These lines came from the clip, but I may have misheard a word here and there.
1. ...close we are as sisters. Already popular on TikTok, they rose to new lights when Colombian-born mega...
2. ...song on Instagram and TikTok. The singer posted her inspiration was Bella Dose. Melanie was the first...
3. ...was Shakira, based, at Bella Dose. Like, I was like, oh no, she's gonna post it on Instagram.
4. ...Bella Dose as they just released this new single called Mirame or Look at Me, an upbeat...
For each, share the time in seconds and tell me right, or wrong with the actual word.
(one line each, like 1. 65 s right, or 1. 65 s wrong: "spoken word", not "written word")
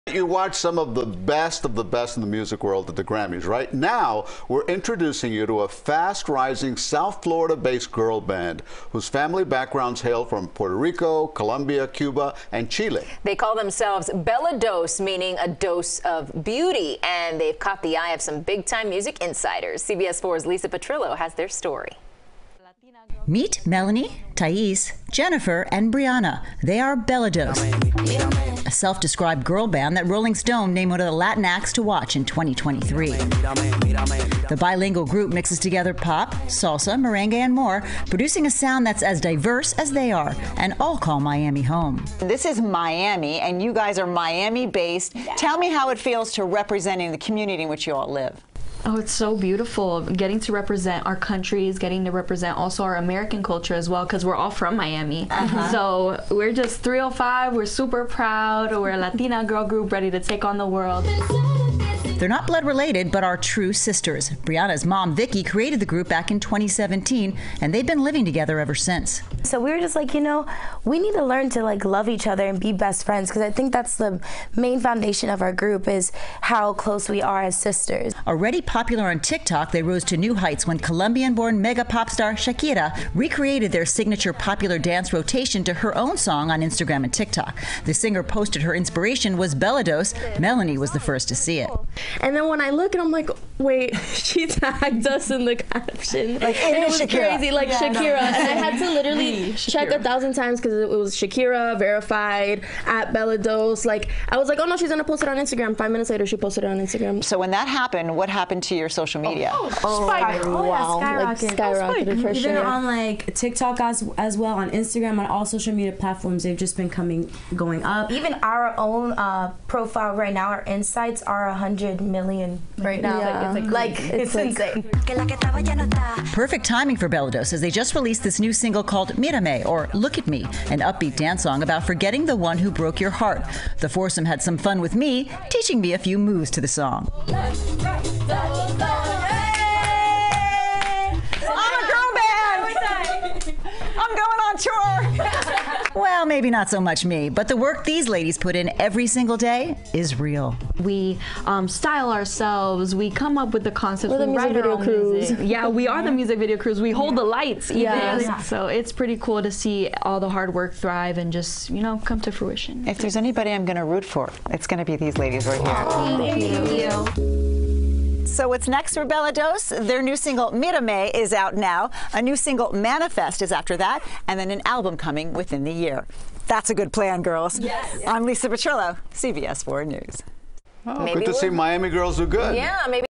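1. 76 s wrong: "heights", not "lights"
2. 86 s right
3. 100 s wrong: "verified", not "based"
4. 127 s right.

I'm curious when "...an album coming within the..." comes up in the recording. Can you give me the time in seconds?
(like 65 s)
174 s.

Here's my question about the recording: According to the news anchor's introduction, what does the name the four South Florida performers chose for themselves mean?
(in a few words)
a dose of beauty.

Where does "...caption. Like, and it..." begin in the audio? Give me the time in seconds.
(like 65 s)
95 s.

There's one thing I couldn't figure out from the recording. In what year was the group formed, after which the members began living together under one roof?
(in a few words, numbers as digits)
2017.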